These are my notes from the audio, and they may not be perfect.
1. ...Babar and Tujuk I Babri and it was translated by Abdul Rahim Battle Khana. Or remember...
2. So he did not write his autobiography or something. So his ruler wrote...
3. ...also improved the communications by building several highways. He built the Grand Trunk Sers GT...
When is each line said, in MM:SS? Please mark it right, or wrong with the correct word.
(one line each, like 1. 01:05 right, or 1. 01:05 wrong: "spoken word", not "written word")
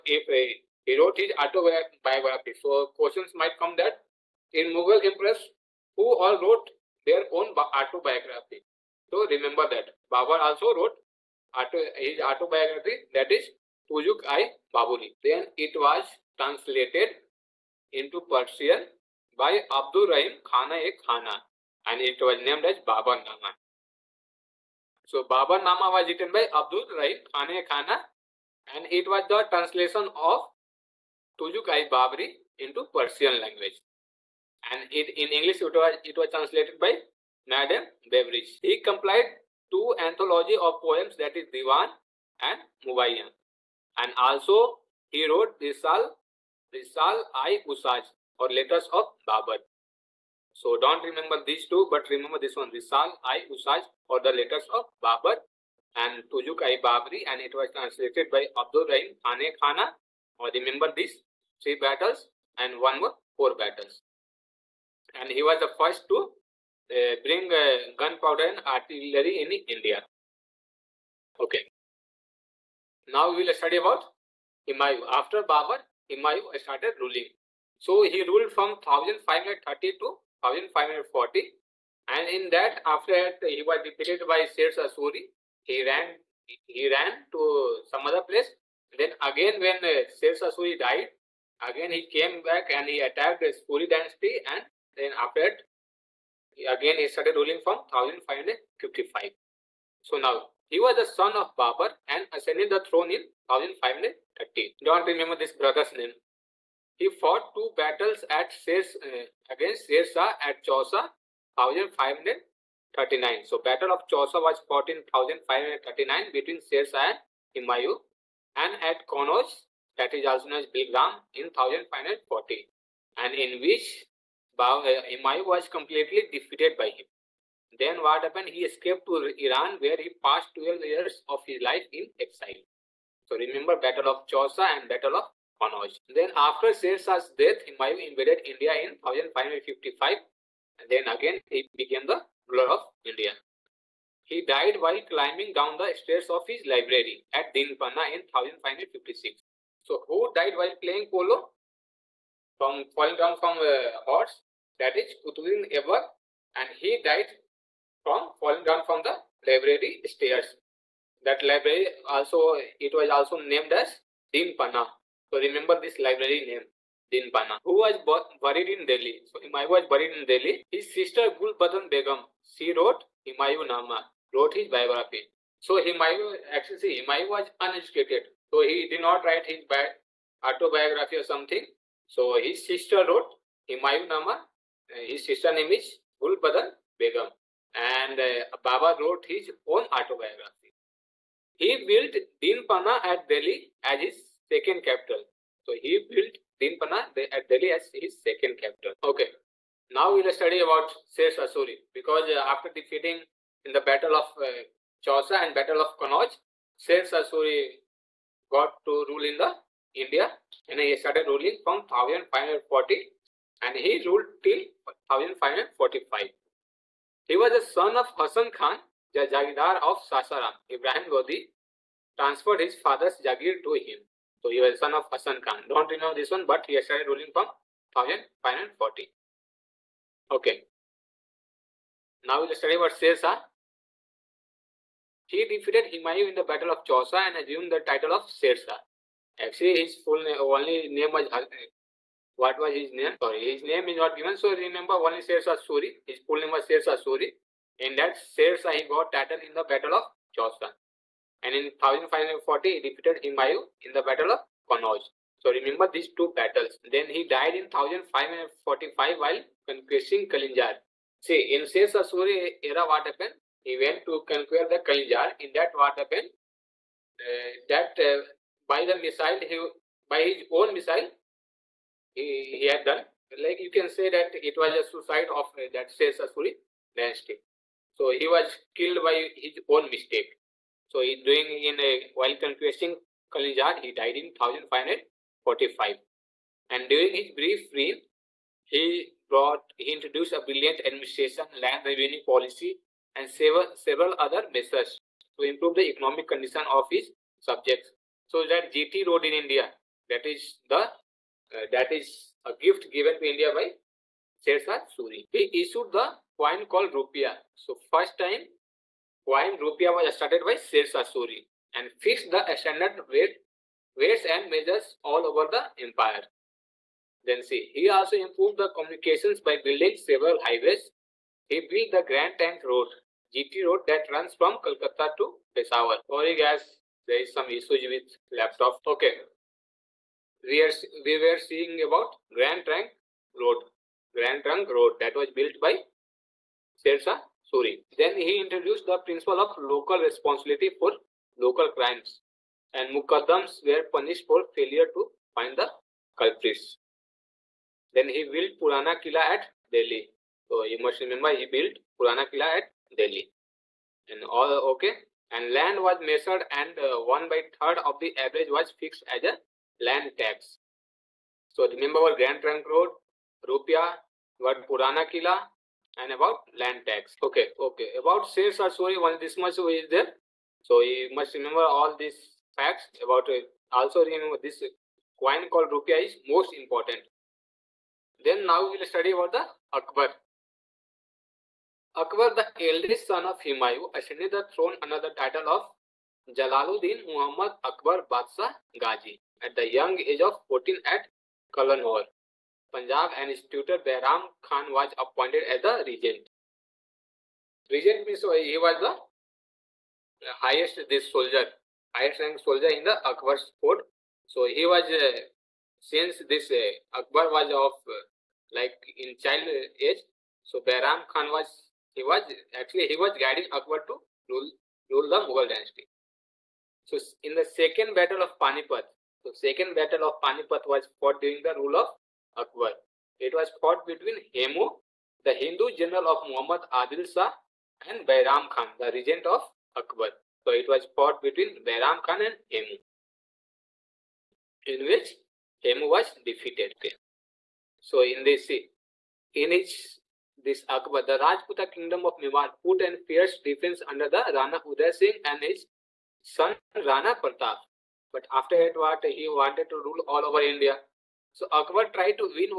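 1. 00:55 wrong: "Khane", not "Battle"
2. 02:58 wrong: "sister", not "ruler"
3. 05:17 wrong: "Road", not "Sers".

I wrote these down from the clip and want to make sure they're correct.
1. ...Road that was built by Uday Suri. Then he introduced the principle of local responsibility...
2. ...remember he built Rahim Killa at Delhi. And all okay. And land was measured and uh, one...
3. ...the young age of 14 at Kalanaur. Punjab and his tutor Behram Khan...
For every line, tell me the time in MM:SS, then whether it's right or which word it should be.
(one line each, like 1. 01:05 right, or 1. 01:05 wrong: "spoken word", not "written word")
1. 05:34 wrong: "Shersa", not "Uday"
2. 05:51 wrong: "Purana", not "Rahim"
3. 06:29 right.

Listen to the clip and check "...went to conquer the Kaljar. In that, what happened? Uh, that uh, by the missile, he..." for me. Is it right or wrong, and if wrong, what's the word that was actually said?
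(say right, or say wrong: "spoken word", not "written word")
right.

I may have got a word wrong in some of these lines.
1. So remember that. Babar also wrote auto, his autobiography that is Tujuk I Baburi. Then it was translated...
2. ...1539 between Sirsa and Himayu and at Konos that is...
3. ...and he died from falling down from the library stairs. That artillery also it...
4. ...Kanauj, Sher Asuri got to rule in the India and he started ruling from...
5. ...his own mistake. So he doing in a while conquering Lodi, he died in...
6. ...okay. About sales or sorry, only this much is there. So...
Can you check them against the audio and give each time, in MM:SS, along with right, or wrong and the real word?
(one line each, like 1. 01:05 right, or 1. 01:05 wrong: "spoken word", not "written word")
1. 00:09 right
2. 01:55 right
3. 02:36 wrong: "library", not "artillery"
4. 03:26 right
5. 04:39 wrong: "Kalinjar", not "Lodi"
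6. 06:07 right.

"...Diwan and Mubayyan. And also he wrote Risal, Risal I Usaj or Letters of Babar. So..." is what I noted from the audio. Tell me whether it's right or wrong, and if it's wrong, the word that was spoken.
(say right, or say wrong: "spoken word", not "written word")
right.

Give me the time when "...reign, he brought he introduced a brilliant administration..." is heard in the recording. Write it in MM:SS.
04:47.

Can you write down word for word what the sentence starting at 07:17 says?
So in this, in his this Akbar.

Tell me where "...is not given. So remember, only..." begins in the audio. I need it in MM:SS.
04:03.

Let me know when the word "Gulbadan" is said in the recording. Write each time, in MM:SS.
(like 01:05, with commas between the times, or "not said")
02:51, 03:06.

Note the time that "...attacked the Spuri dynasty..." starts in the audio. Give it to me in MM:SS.
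01:33.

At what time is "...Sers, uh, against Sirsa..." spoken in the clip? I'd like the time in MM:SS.
01:48.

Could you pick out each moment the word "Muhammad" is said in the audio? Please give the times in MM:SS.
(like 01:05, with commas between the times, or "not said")
06:27, 07:06.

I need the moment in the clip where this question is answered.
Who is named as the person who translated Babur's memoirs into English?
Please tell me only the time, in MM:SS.
00:37.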